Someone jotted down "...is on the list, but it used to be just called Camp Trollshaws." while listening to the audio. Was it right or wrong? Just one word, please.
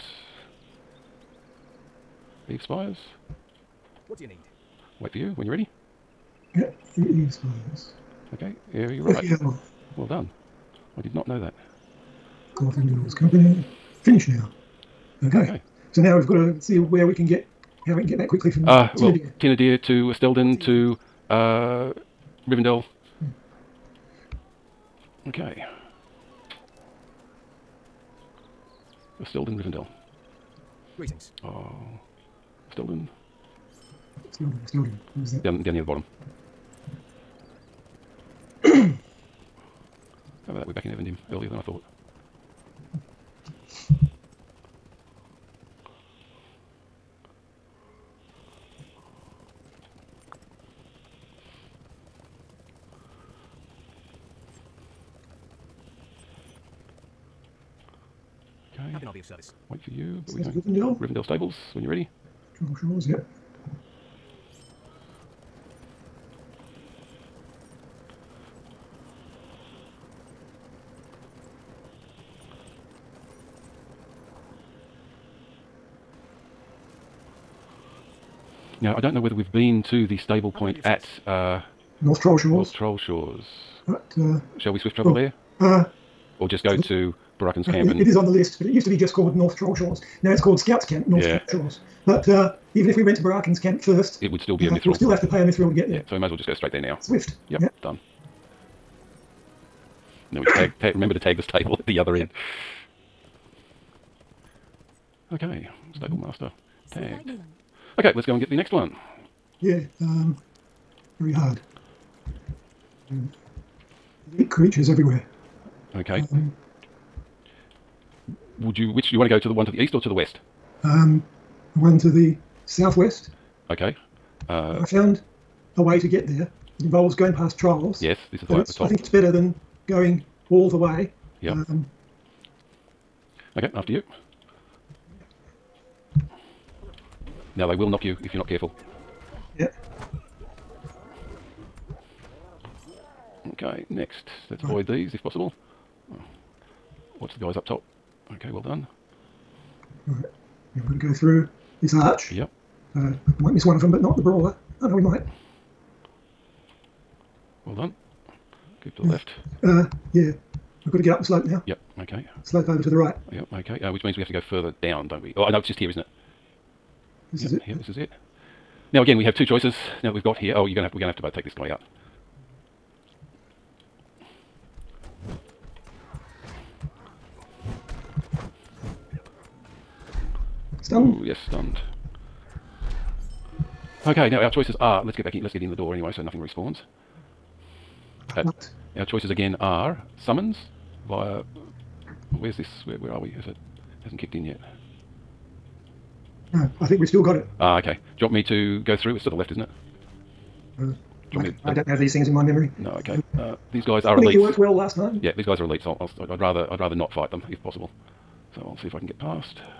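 wrong.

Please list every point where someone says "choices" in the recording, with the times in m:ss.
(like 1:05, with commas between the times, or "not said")
2:49, 3:04, 3:09.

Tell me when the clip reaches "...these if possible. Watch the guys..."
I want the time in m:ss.
2:24.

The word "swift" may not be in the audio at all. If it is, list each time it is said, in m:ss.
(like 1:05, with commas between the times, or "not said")
1:24, 1:37.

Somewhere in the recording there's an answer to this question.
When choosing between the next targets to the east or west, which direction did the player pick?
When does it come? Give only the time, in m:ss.
2:02.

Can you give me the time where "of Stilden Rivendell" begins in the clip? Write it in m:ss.
0:29.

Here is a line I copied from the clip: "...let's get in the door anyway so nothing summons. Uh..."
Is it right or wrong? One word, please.
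wrong.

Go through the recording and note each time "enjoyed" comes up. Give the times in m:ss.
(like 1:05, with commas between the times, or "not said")
not said.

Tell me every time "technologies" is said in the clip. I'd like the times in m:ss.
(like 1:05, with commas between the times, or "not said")
not said.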